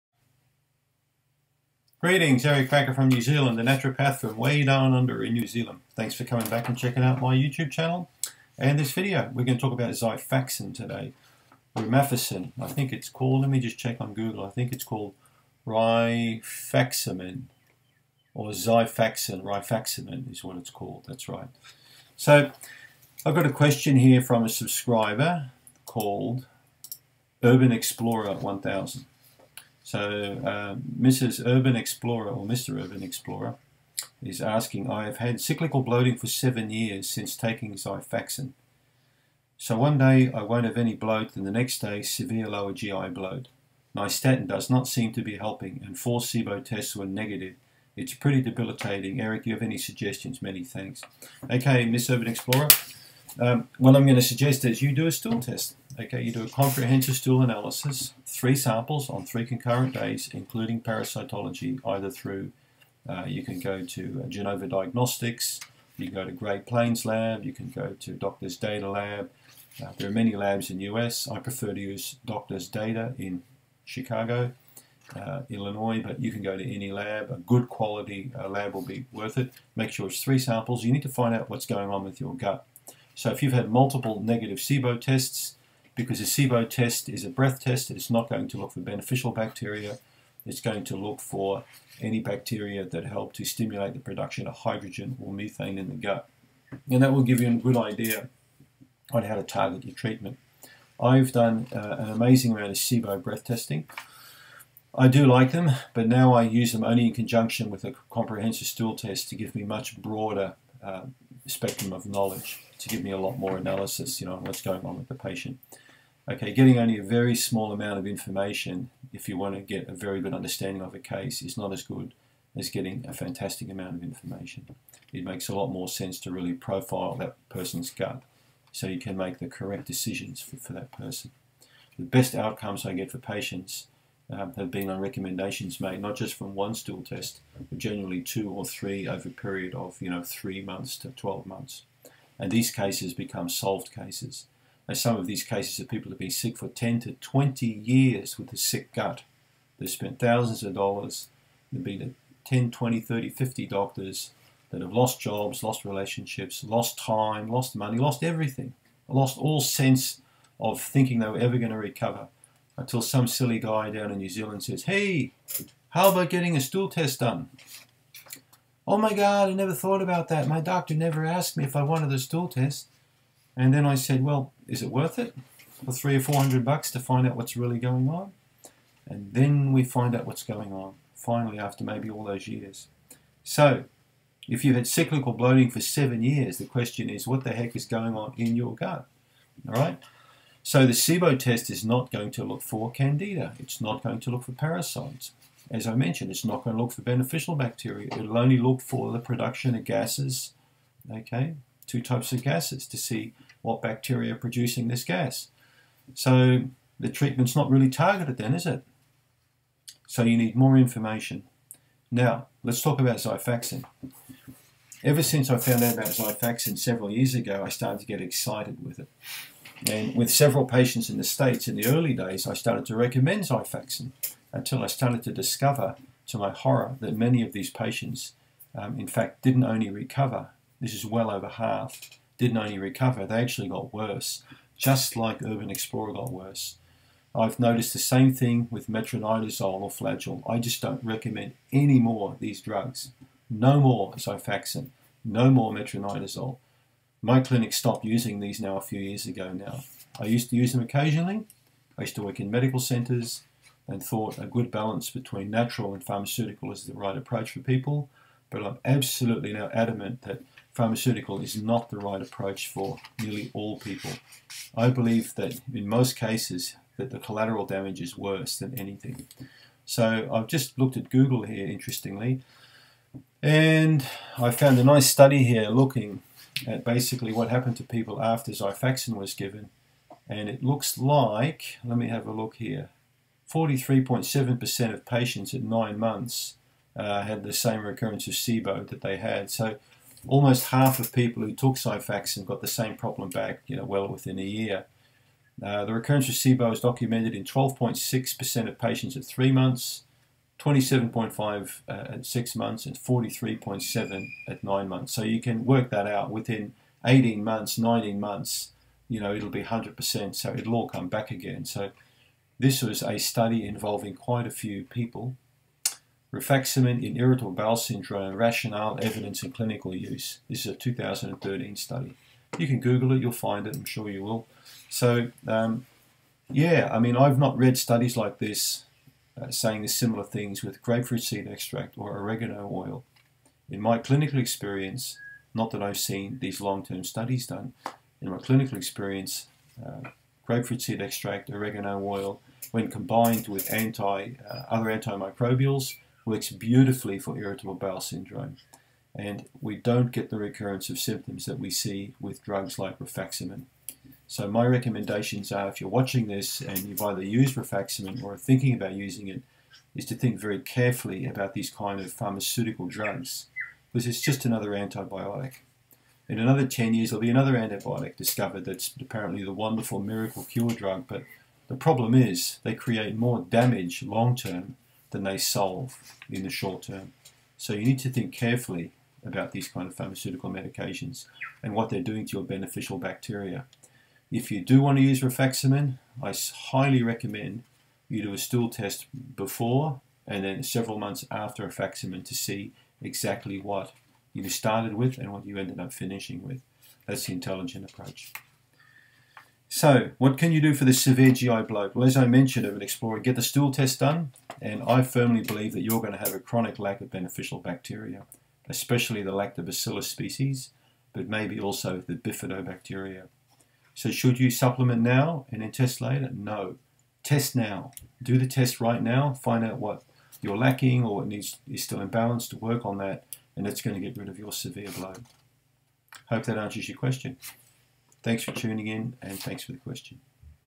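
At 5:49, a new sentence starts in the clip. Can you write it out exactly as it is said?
And we don't get the recurrence of symptoms that we see with drugs like rifaximin.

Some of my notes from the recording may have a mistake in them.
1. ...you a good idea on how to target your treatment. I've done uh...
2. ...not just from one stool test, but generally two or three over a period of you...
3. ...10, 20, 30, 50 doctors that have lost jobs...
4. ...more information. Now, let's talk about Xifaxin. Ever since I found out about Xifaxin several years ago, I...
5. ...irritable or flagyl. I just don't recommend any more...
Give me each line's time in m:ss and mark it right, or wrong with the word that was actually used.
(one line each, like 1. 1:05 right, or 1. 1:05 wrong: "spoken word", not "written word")
1. 1:37 right
2. 2:16 right
3. 2:32 right
4. 3:30 right
5. 3:58 wrong: "metronidazole", not "irritable".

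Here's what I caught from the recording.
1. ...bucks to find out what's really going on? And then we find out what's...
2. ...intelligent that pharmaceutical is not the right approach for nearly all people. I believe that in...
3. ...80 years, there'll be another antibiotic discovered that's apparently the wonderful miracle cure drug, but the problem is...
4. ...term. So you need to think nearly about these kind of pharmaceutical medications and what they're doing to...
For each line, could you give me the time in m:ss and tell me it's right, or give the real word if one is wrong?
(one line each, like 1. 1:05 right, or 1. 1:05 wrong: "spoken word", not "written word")
1. 2:56 right
2. 4:19 wrong: "adamant", not "intelligent"
3. 6:06 wrong: "10", not "80"
4. 6:16 wrong: "carefully", not "nearly".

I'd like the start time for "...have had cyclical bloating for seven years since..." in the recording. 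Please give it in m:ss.
0:35.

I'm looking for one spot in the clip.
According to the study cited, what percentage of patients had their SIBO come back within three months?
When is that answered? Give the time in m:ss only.
4:57.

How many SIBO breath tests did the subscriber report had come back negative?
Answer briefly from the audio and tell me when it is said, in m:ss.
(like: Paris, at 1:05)
4, at 0:45.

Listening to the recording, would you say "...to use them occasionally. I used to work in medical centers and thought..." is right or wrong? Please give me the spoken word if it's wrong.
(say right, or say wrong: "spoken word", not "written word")
right.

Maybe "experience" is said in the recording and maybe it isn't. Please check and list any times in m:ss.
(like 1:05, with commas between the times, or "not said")
5:34, 5:38.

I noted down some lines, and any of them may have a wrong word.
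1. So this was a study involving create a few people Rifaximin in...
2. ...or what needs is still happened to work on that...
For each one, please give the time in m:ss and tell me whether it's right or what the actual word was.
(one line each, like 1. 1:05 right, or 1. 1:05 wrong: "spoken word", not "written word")
1. 5:11 wrong: "quite", not "create"
2. 7:01 wrong: "imbalanced", not "happened".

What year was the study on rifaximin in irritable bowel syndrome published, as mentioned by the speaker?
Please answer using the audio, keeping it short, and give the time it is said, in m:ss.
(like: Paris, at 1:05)
2013, at 5:20.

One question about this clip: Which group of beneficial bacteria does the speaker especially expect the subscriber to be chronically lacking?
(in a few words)
lactobacillus.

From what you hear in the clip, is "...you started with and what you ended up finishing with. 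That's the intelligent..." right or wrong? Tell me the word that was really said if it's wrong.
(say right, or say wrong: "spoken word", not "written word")
right.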